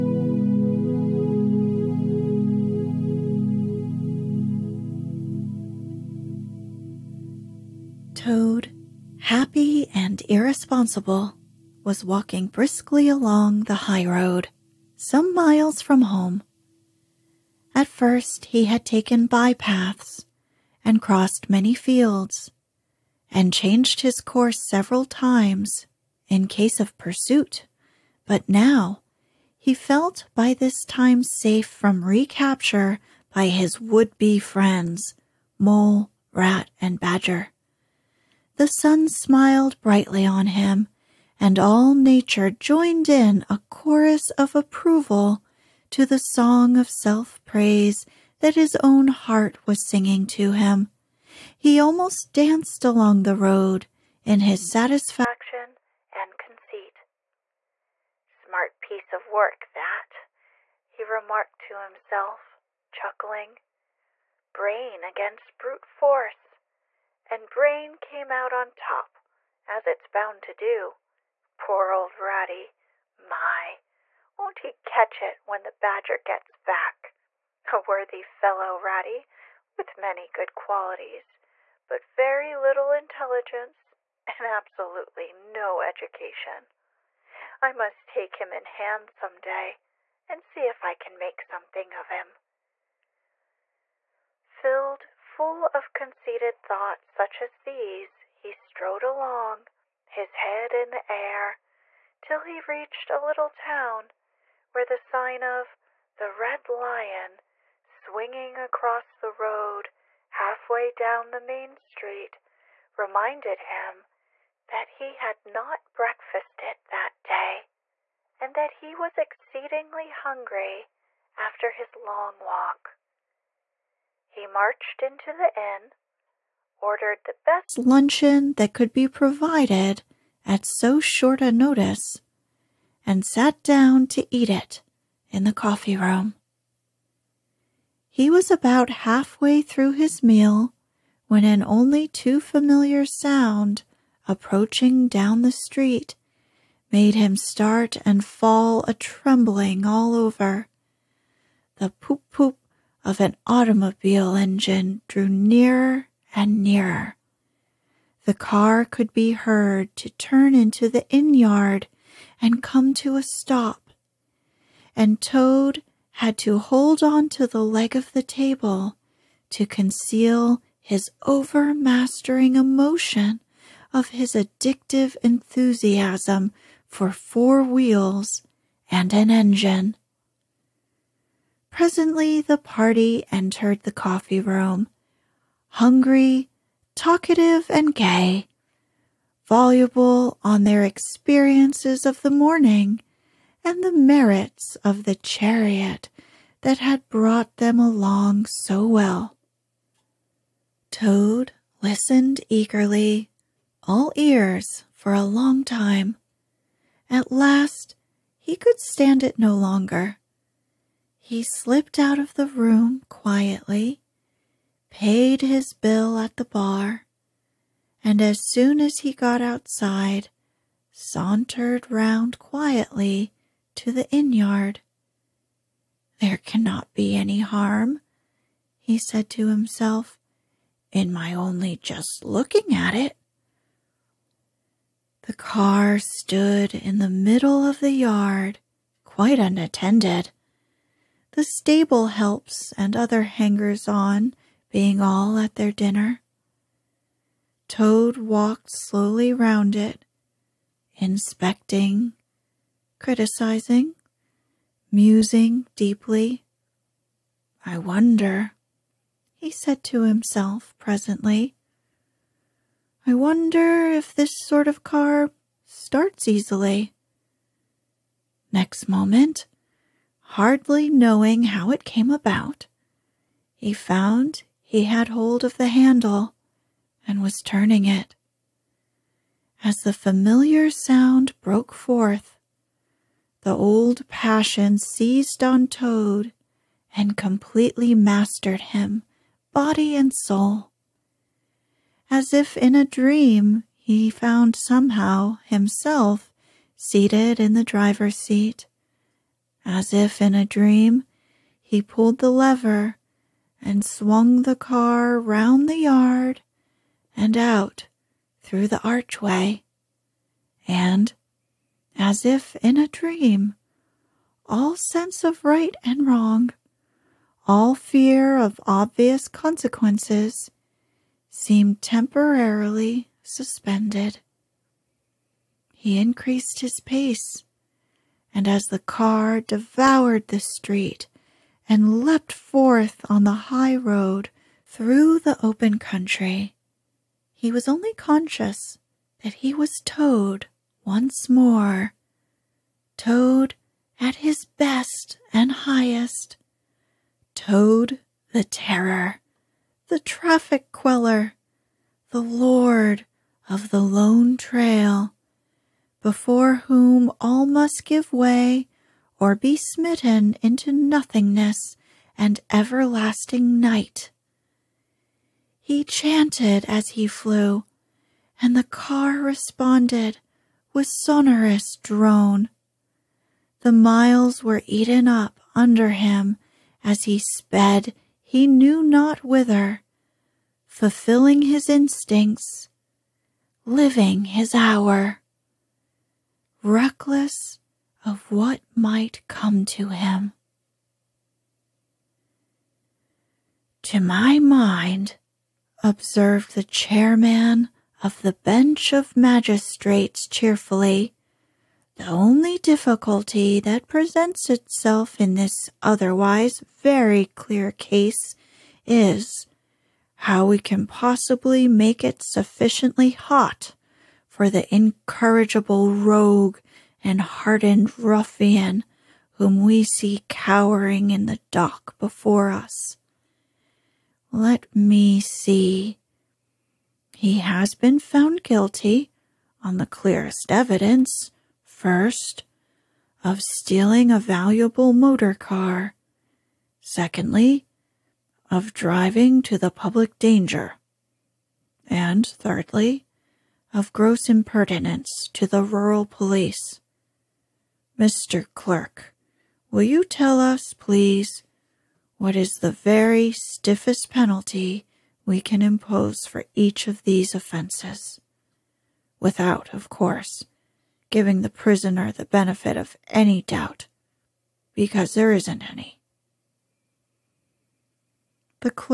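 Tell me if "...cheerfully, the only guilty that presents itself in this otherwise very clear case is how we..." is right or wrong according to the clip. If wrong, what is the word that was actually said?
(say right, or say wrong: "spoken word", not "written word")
wrong: "difficulty", not "guilty".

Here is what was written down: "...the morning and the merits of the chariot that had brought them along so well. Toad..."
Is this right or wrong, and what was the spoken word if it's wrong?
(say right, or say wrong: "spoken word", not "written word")
right.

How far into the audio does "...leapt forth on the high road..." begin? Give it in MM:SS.
05:32.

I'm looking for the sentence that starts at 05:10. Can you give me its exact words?
And, as if in a dream, all sense of right and wrong, all fear of obvious consequences, seemed temporarily suspended.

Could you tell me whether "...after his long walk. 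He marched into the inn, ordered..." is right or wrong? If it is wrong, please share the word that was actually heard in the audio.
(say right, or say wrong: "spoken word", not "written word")
right.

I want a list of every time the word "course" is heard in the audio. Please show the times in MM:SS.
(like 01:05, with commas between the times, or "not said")
00:24, 07:39.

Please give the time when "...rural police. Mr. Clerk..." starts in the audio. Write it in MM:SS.
07:25.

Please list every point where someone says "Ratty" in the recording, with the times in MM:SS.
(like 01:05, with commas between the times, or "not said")
01:12, 01:18.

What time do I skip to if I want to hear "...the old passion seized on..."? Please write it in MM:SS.
04:43.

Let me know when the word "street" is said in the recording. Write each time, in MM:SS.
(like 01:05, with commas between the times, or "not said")
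01:51, 02:25, 05:30.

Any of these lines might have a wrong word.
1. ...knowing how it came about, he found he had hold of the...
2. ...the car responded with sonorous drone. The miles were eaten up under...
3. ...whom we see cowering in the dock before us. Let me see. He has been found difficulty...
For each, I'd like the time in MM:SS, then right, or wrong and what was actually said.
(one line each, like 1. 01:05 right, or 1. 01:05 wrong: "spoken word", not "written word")
1. 04:30 right
2. 06:08 right
3. 06:59 wrong: "guilty", not "difficulty".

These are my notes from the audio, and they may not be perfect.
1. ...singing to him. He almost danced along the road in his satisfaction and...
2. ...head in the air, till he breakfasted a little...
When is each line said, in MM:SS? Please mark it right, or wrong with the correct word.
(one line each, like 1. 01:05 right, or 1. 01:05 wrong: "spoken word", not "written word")
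1. 00:49 right
2. 01:40 wrong: "reached", not "breakfasted".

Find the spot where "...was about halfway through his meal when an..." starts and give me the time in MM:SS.
02:18.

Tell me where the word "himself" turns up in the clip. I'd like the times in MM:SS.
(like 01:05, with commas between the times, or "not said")
01:01, 03:49, 04:20, 04:55.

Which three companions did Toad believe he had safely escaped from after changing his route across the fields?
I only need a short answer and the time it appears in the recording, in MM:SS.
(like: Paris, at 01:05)
Mole, Rat, and Badger, at 00:35.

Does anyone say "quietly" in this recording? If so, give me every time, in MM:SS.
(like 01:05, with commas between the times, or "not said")
03:33, 03:42.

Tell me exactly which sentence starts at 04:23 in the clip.
I wonder if this sort of car starts easily.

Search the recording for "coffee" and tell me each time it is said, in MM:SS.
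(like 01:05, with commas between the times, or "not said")
02:15, 03:03.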